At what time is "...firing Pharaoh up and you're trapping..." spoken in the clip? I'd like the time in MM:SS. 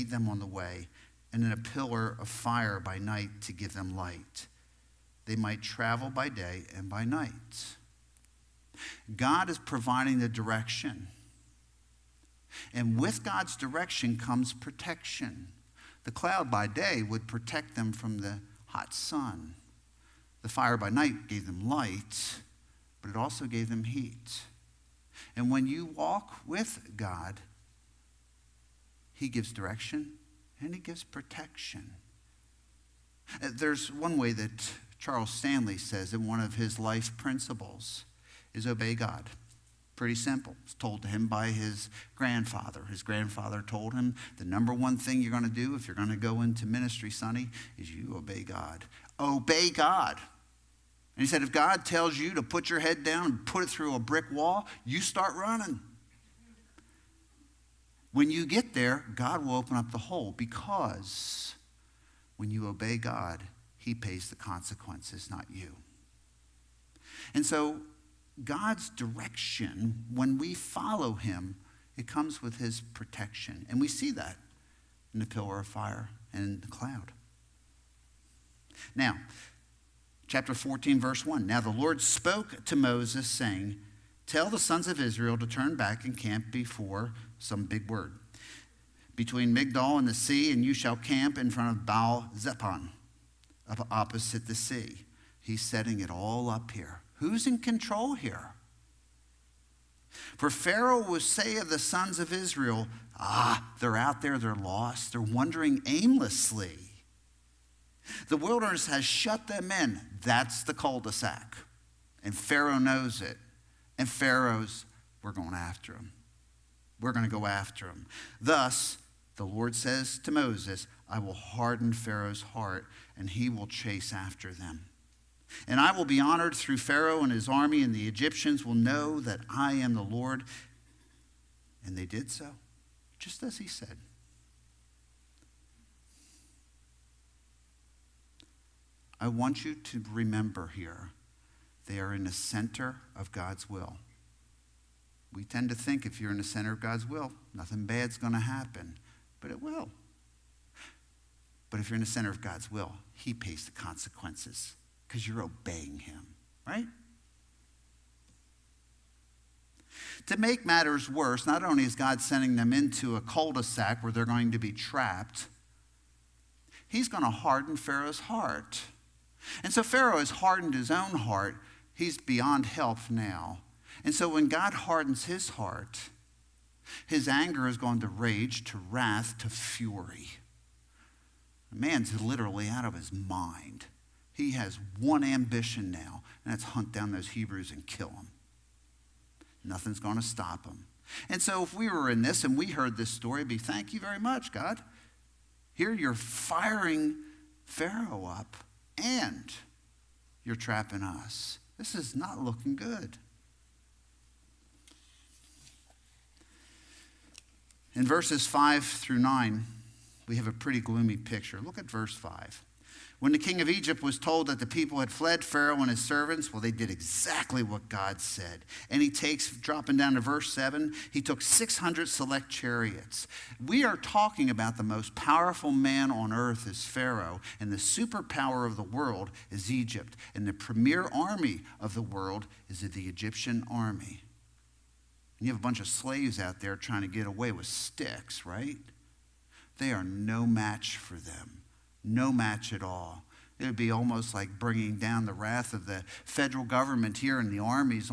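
03:16.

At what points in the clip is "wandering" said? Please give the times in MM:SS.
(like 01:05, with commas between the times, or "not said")
01:45.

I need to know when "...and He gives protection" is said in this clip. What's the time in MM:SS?
00:30.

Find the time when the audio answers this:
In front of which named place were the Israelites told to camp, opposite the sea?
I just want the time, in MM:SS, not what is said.
01:31.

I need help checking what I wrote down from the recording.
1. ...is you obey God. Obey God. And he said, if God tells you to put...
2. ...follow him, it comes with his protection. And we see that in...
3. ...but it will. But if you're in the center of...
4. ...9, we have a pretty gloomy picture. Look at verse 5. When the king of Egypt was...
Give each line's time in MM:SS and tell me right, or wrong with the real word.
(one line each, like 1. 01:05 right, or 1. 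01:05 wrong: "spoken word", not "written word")
1. 00:47 right
2. 01:10 right
3. 02:29 right
4. 03:29 right.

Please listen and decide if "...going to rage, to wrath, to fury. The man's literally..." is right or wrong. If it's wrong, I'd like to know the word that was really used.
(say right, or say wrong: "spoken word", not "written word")
right.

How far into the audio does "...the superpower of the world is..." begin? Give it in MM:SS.
03:47.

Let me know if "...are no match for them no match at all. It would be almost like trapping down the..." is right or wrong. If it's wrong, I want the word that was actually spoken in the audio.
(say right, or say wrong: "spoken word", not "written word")
wrong: "bringing", not "trapping".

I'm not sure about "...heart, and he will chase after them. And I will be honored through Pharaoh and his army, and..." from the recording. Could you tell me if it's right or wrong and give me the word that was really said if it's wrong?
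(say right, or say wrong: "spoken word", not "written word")
right.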